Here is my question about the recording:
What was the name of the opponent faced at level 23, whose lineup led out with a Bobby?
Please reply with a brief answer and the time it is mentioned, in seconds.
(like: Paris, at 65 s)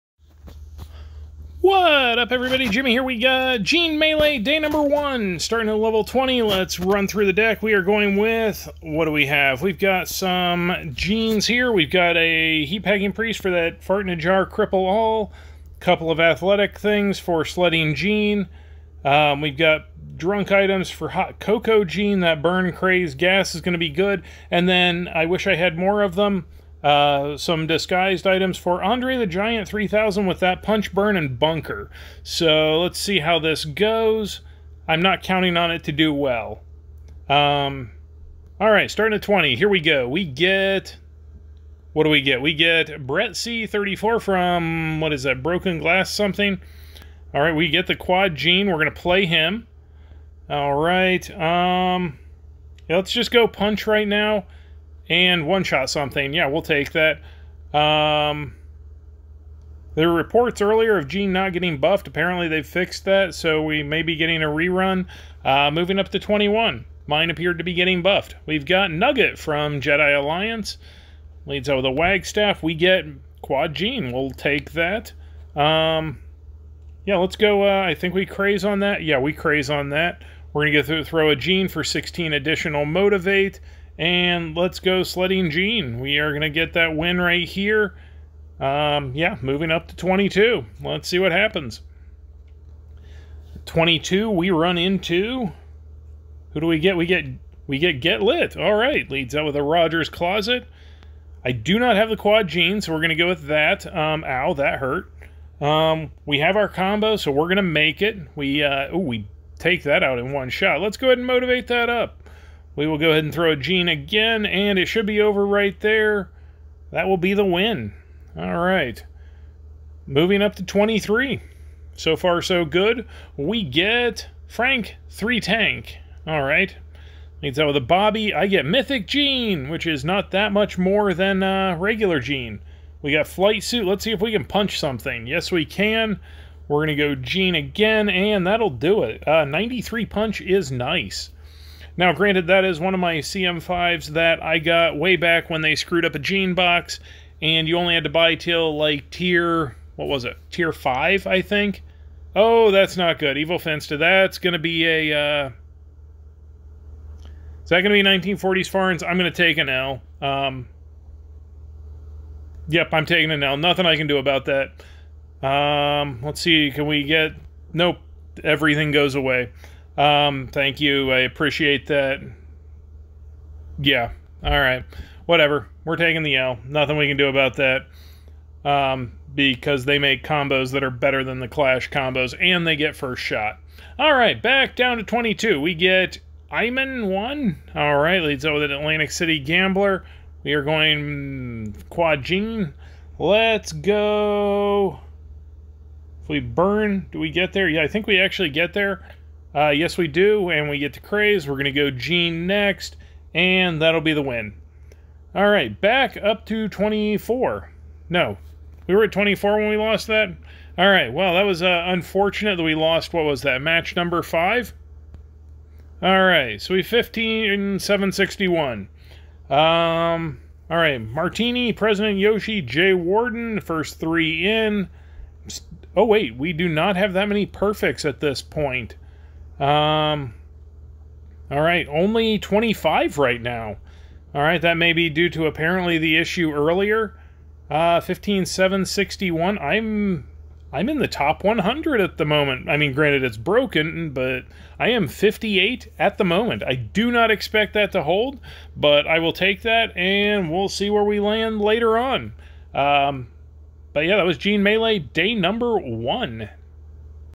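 Frank 3 Tank, at 124 s.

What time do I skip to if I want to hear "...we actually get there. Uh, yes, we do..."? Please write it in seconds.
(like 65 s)
198 s.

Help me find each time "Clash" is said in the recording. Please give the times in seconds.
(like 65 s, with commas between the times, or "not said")
181 s.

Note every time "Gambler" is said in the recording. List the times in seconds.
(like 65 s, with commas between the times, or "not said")
189 s.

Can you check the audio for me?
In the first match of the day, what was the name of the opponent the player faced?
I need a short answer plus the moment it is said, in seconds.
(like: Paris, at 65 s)
Brett C34, at 43 s.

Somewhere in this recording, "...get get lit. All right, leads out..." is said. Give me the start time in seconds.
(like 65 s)
97 s.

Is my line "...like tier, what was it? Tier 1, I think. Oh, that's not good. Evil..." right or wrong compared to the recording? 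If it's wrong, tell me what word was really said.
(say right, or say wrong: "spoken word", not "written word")
wrong: "5", not "1".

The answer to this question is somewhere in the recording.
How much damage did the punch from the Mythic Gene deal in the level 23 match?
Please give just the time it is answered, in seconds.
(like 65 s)
139 s.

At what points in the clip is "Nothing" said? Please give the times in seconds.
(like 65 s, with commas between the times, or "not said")
163 s, 176 s.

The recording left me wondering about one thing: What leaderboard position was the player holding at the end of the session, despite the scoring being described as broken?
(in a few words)
58.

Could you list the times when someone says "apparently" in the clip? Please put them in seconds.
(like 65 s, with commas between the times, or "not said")
62 s, 235 s.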